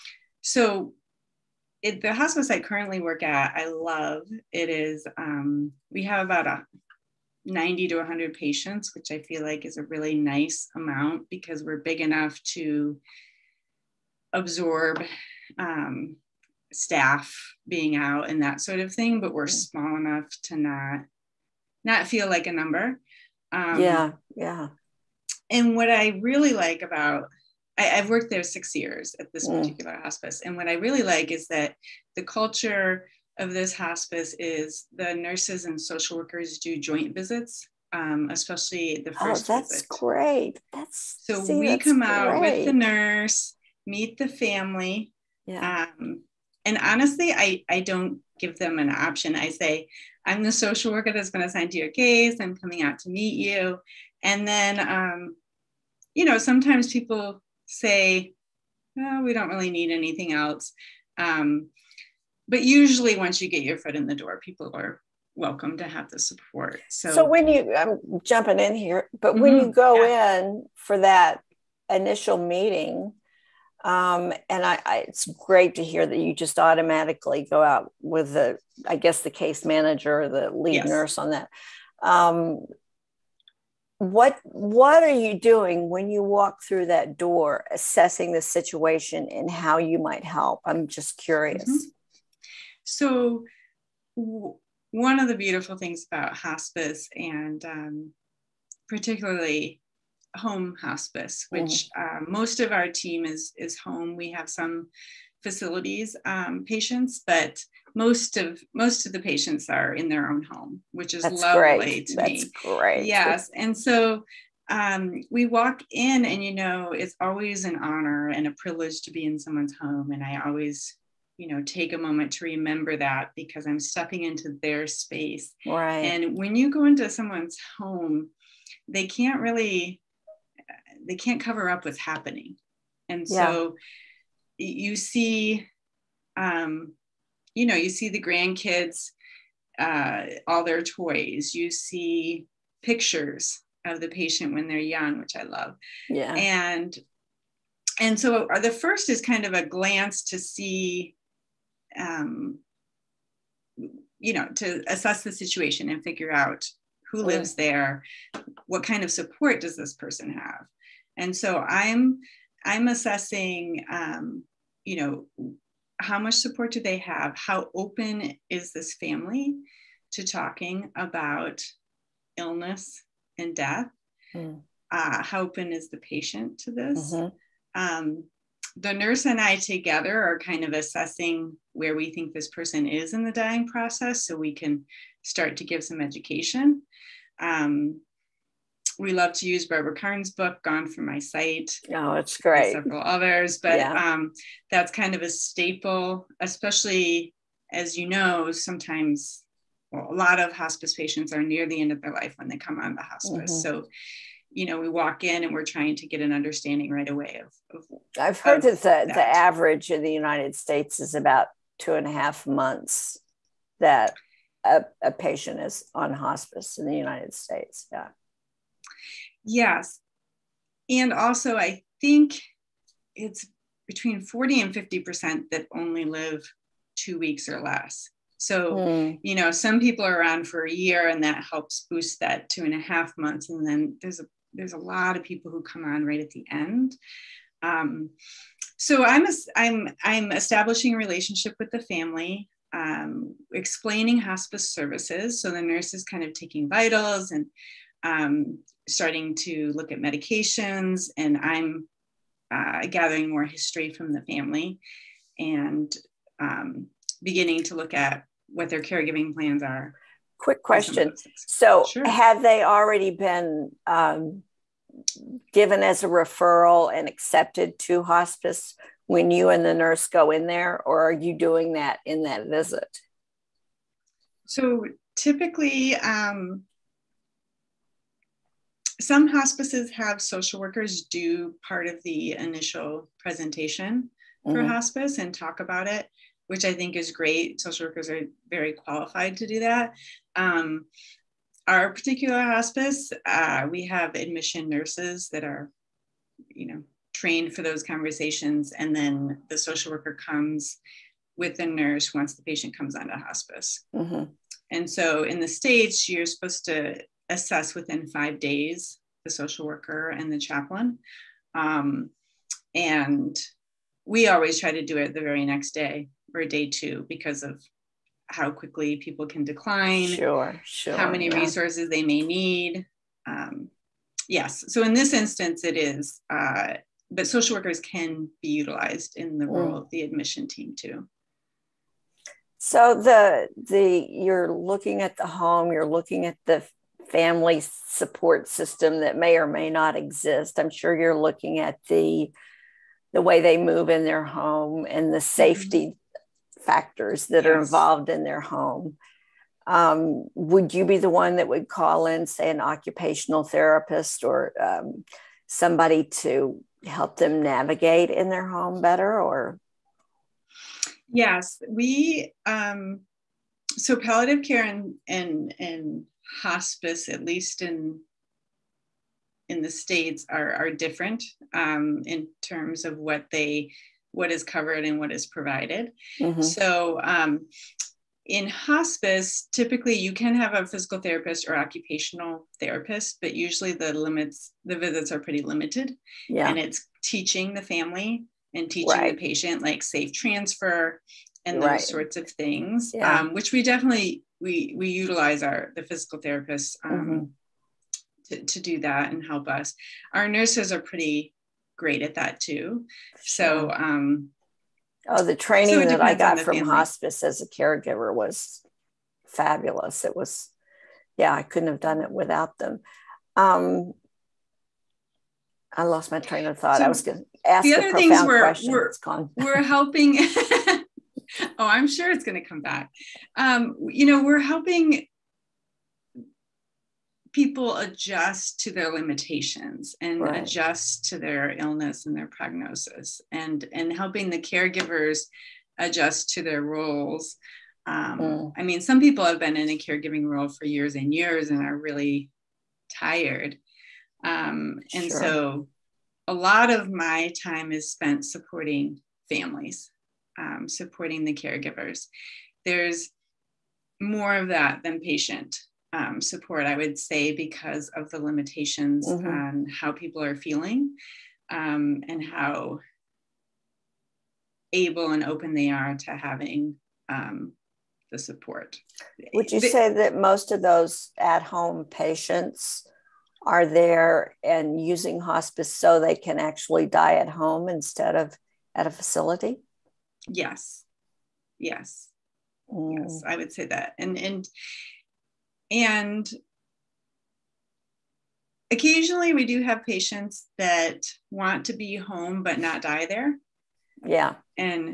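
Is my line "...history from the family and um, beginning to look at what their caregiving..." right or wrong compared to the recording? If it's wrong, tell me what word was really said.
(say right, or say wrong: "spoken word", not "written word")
right.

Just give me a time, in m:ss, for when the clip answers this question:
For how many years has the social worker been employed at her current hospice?
0:28.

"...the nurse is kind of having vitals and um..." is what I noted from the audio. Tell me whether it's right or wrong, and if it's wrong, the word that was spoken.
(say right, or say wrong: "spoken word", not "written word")
wrong: "taking", not "having".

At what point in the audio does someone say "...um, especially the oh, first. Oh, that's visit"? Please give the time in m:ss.
0:37.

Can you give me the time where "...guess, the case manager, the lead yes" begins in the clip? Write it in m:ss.
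1:18.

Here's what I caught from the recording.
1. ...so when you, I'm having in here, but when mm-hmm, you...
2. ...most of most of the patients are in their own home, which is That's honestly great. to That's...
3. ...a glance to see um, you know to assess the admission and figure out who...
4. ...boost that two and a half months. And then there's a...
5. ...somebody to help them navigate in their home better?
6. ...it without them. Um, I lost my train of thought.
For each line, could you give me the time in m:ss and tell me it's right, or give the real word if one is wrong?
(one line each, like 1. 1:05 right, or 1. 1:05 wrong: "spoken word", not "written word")
1. 1:07 wrong: "jumping", not "having"
2. 1:47 wrong: "lovely", not "honestly"
3. 2:29 wrong: "situation", not "admission"
4. 3:51 right
5. 5:55 right
6. 6:52 right.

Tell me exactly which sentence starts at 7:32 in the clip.
There's more of that than patient um, support, I would say, because of the limitations mm-hmm.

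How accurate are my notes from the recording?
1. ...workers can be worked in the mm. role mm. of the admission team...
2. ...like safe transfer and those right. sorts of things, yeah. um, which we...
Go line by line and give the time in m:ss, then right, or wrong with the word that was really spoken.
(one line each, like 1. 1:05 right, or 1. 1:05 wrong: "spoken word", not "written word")
1. 5:27 wrong: "utilized", not "worked"
2. 6:29 right.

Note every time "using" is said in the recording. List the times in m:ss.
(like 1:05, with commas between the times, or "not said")
7:54.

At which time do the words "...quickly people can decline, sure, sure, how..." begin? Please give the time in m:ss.
5:18.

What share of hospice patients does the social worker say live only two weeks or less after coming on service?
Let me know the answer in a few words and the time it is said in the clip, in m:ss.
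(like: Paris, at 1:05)
40 to 50%, at 3:43.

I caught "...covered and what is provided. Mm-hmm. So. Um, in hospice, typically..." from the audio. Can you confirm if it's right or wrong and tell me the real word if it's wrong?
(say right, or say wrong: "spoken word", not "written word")
right.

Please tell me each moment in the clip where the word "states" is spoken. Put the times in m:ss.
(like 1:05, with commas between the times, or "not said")
3:30, 3:37, 5:05, 6:09.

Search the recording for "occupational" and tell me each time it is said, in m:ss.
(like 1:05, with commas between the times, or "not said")
5:52, 6:21.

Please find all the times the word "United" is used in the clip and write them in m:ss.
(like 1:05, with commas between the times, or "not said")
3:30, 3:36.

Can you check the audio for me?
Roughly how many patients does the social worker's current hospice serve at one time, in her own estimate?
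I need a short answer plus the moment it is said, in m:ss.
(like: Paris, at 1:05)
90 to 100, at 0:07.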